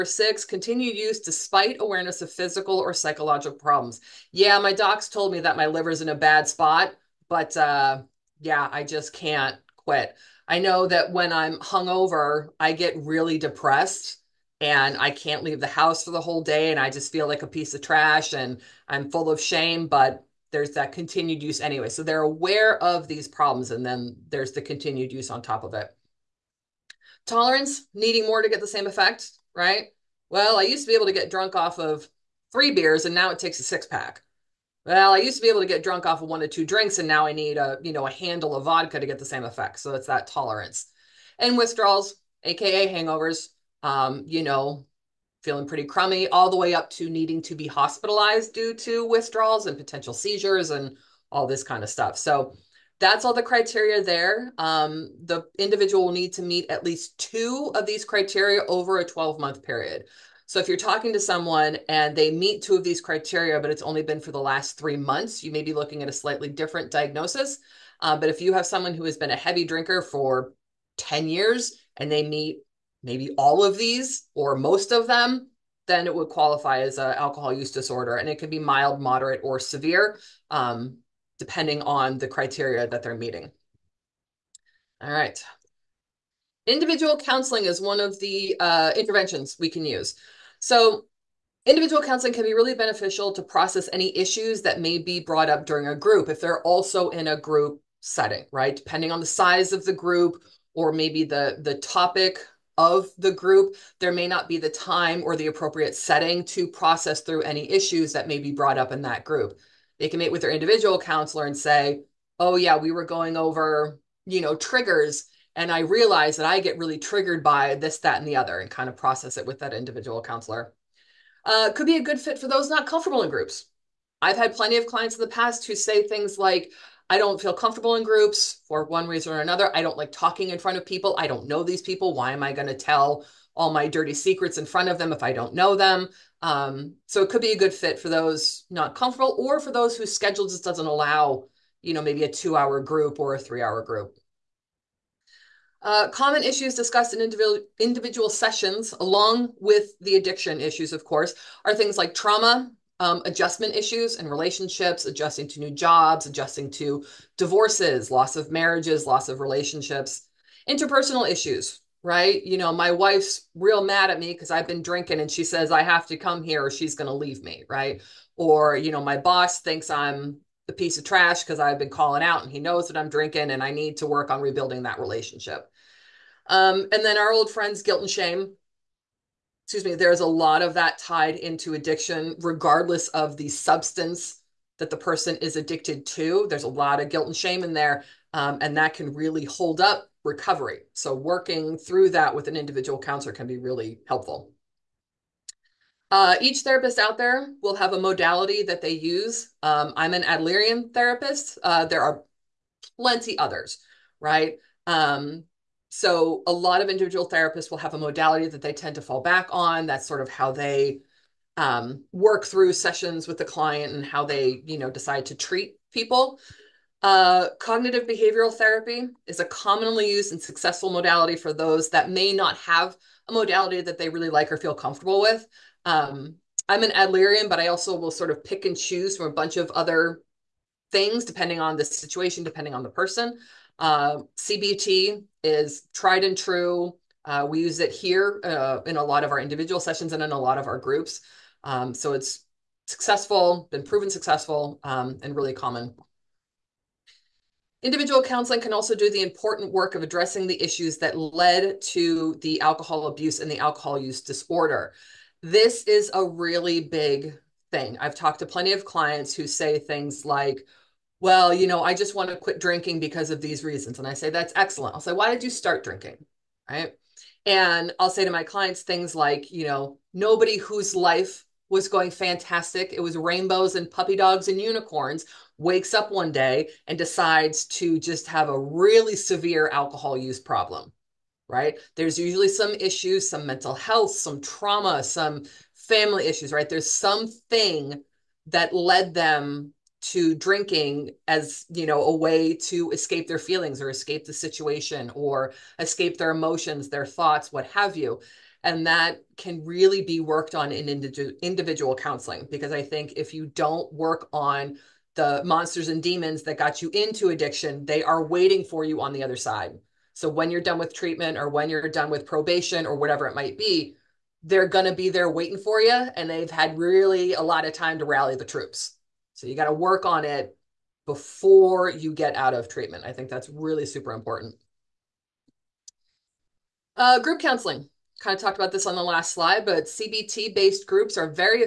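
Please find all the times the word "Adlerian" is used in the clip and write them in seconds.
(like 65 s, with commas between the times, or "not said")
200 s, 226 s.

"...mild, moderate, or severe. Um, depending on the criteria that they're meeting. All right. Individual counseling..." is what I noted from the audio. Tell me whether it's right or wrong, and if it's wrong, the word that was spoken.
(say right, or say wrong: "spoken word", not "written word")
right.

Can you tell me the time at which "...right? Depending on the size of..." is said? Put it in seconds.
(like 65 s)
98 s.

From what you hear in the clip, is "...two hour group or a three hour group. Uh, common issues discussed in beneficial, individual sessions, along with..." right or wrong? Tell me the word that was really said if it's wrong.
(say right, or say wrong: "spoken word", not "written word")
wrong: "individual", not "beneficial".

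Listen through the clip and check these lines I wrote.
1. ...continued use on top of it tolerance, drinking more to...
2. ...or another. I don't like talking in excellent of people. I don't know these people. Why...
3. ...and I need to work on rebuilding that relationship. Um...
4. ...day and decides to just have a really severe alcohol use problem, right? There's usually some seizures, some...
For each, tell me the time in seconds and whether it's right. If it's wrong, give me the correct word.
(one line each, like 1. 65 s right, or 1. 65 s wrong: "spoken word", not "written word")
1. 24 s wrong: "needing", not "drinking"
2. 129 s wrong: "front", not "excellent"
3. 173 s right
4. 276 s wrong: "issues", not "seizures".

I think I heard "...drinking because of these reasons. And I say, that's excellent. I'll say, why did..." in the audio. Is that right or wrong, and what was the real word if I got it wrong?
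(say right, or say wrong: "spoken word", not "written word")
right.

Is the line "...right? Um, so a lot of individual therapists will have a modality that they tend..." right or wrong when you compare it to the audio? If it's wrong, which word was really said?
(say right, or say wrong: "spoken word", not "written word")
right.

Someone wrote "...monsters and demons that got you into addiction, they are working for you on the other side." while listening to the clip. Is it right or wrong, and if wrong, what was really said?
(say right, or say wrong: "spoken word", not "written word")
wrong: "waiting", not "working".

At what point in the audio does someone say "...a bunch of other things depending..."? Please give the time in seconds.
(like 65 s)
229 s.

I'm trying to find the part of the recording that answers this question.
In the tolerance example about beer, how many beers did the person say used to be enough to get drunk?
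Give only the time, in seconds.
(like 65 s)
32 s.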